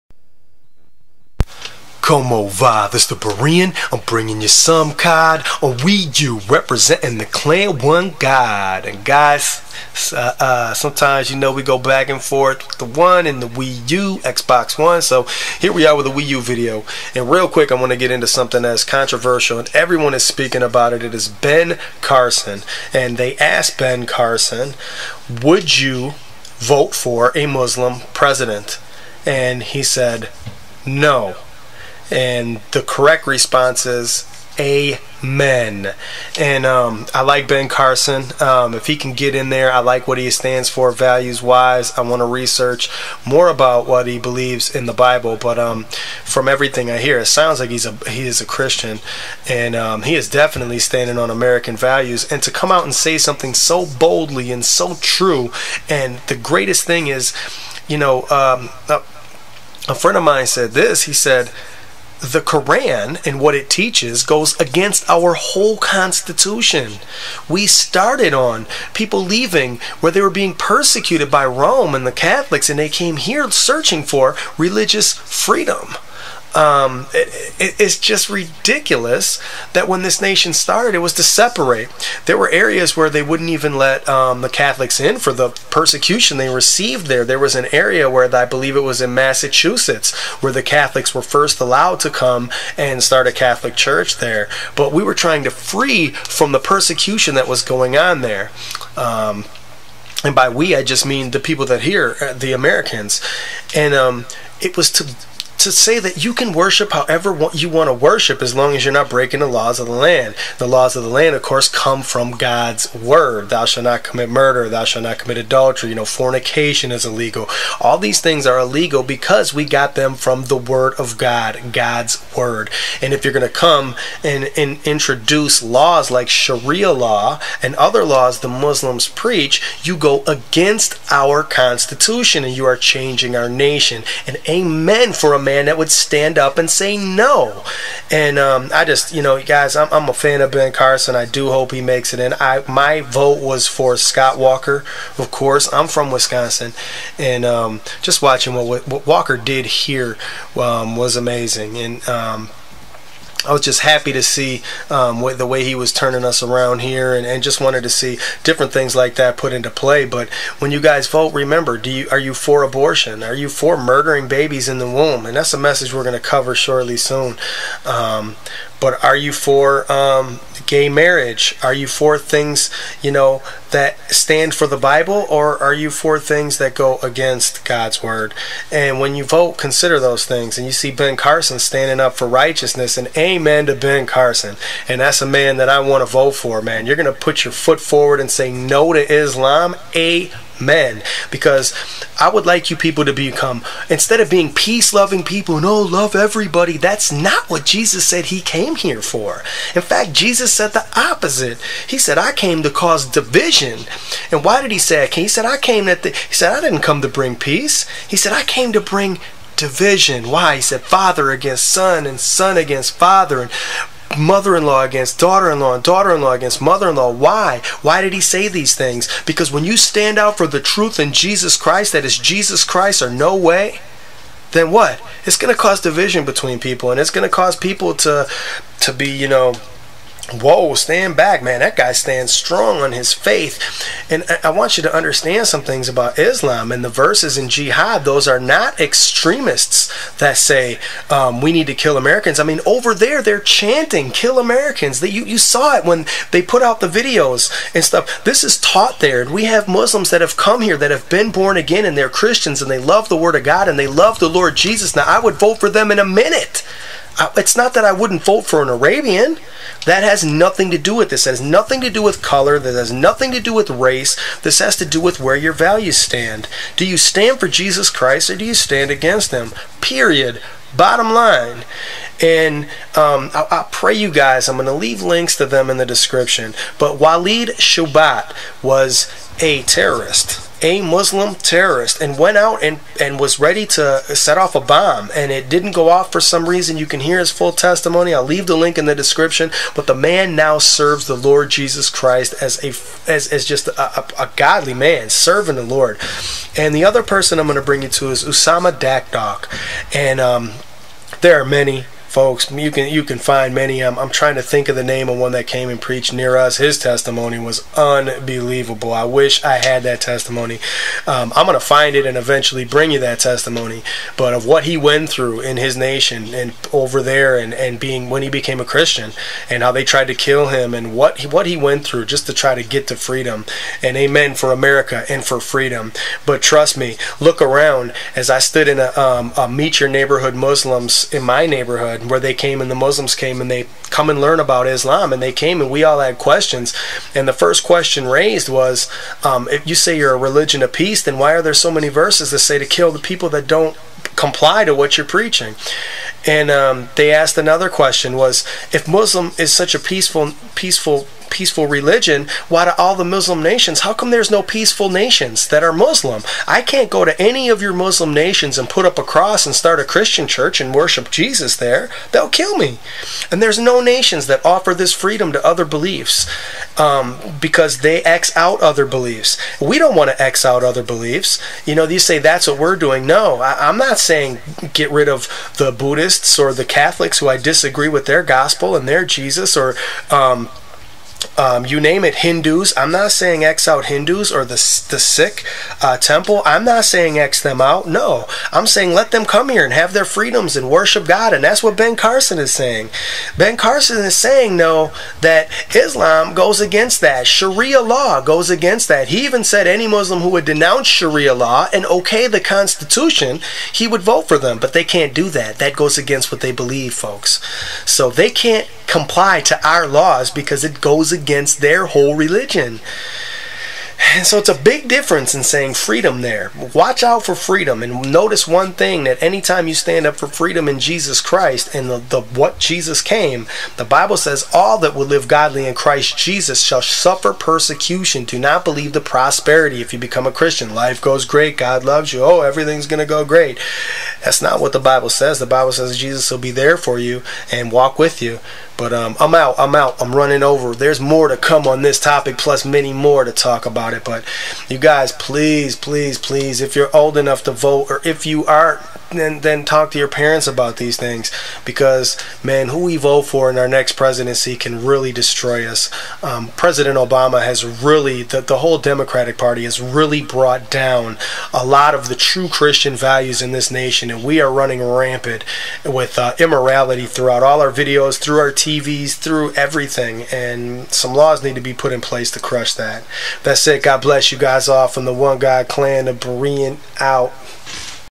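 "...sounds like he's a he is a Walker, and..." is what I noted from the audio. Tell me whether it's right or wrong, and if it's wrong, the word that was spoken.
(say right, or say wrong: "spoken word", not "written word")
wrong: "Christian", not "Walker".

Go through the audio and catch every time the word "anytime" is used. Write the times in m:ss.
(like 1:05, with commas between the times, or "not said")
6:59.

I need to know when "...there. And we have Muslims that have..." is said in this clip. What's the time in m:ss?
4:08.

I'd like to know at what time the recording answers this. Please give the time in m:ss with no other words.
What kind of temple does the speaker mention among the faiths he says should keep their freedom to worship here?
6:24.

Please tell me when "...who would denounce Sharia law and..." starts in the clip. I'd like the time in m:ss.
6:40.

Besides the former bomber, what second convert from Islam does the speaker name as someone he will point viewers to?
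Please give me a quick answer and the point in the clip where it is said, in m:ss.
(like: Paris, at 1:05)
Usama Dakdok, at 4:58.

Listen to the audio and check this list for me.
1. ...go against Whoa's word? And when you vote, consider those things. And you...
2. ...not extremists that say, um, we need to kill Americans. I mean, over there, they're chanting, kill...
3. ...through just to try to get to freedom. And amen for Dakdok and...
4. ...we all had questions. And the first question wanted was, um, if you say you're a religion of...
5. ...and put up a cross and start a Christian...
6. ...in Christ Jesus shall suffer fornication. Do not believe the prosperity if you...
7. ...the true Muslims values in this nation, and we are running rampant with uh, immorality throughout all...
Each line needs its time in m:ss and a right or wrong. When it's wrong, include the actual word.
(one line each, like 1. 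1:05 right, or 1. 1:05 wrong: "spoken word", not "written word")
1. 2:56 wrong: "God", not "Whoa"
2. 3:58 right
3. 5:21 wrong: "America", not "Dakdok"
4. 5:35 wrong: "raised", not "wanted"
5. 5:58 right
6. 7:05 wrong: "persecution", not "fornication"
7. 7:42 wrong: "Christian", not "Muslims".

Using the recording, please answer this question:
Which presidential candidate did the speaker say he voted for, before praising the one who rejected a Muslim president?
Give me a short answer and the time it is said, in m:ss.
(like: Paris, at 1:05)
Scott Walker, at 2:23.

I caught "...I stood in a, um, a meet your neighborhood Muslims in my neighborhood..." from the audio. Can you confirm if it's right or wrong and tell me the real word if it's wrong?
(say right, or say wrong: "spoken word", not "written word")
right.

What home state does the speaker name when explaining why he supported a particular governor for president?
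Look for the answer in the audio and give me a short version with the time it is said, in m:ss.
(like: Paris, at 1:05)
Wisconsin, at 2:26.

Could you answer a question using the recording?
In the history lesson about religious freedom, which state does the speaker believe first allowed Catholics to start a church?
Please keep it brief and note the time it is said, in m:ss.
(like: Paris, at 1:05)
Massachusetts, at 1:29.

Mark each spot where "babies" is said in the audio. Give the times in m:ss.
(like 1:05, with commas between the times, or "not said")
2:44.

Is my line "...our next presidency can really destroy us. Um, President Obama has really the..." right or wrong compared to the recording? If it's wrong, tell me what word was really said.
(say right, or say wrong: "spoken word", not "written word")
right.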